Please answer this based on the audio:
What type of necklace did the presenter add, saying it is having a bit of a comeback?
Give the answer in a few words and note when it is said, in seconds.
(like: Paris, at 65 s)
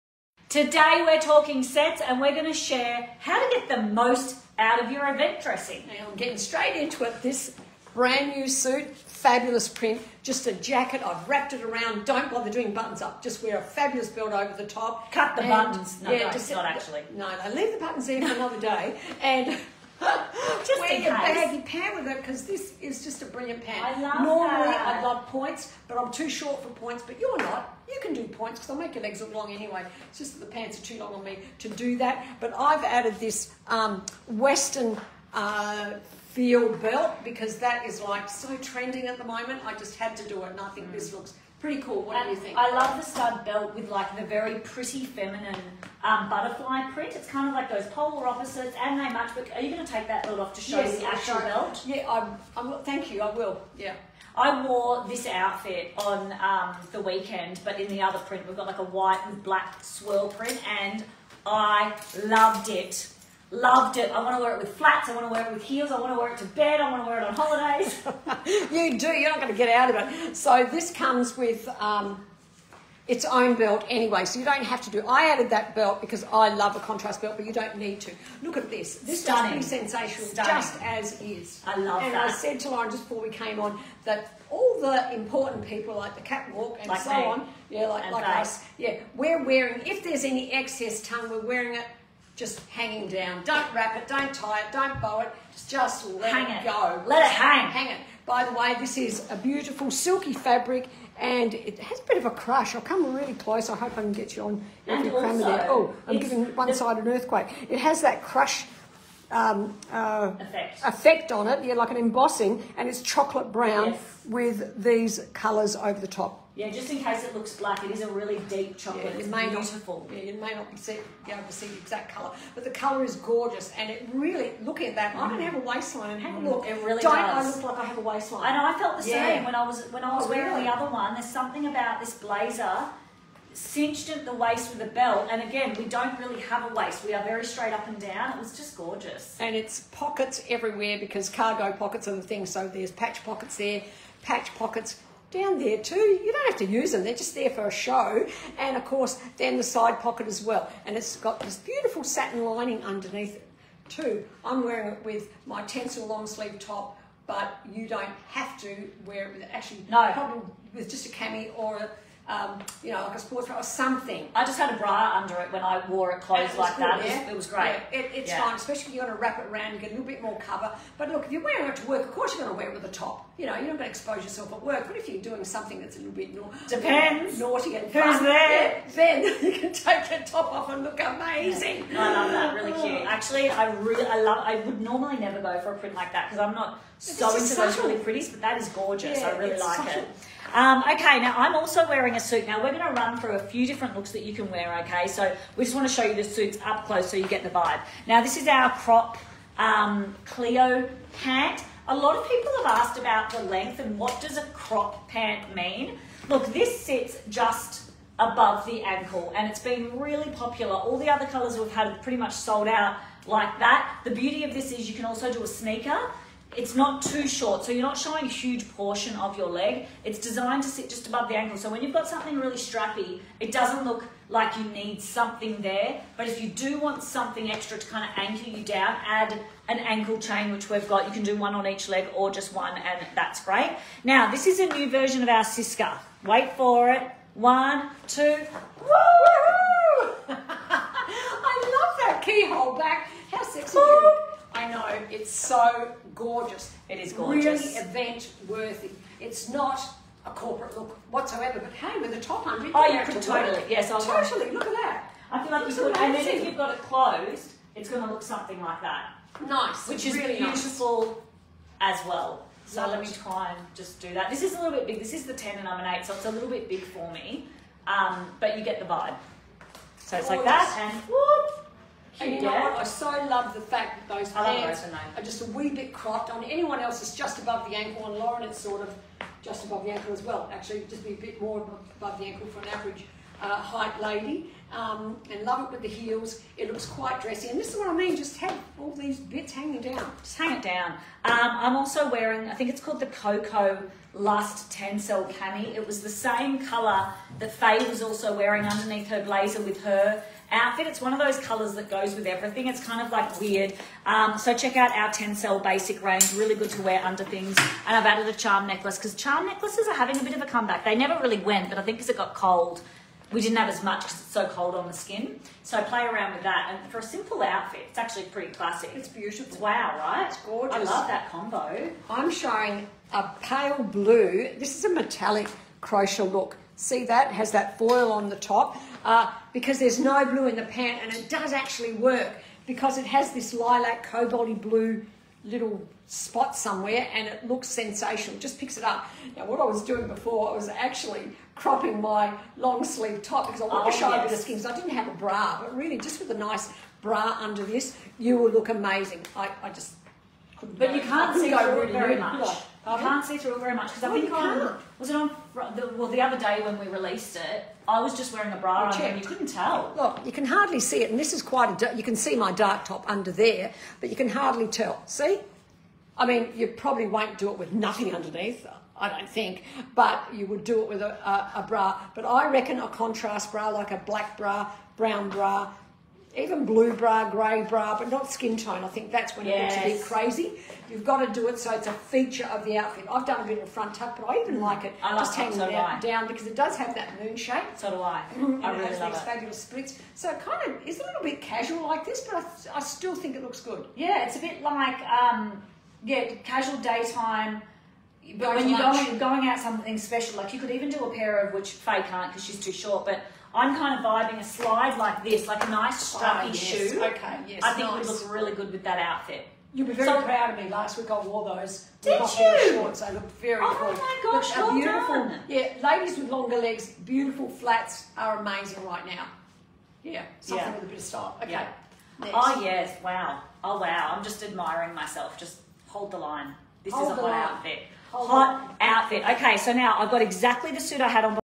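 Charm necklace, at 308 s.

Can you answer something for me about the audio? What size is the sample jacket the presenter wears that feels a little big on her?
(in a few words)
10.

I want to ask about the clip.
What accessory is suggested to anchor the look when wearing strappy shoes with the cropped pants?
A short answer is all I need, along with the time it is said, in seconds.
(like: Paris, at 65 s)
Ankle chain, at 229 s.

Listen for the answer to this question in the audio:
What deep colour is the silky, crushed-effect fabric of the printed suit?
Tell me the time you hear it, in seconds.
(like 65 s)
113 s.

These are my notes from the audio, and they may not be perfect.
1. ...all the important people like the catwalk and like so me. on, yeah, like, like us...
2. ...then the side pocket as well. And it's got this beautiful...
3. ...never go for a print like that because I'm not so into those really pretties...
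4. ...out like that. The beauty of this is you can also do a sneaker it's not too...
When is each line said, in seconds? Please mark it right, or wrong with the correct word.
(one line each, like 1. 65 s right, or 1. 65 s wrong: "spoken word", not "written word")
1. 84 s right
2. 149 s right
3. 185 s right
4. 212 s right.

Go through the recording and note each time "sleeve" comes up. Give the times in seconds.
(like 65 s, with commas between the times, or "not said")
156 s, 342 s.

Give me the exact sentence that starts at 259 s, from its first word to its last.
Nice, which is really beautiful nice.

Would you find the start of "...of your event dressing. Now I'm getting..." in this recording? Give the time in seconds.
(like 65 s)
4 s.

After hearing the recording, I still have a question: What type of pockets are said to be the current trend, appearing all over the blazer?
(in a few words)
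Cargo pockets.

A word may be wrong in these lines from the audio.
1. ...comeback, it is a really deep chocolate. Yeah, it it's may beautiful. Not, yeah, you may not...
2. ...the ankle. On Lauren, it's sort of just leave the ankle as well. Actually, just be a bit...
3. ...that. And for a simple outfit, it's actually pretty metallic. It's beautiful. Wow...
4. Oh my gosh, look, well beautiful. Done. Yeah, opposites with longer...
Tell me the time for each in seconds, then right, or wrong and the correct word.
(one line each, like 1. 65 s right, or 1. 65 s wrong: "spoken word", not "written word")
1. 117 s wrong: "black", not "comeback"
2. 277 s wrong: "above", not "leave"
3. 316 s wrong: "classic", not "metallic"
4. 413 s wrong: "ladies", not "opposites".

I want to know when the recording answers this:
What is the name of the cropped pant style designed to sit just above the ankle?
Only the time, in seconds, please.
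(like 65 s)
200 s.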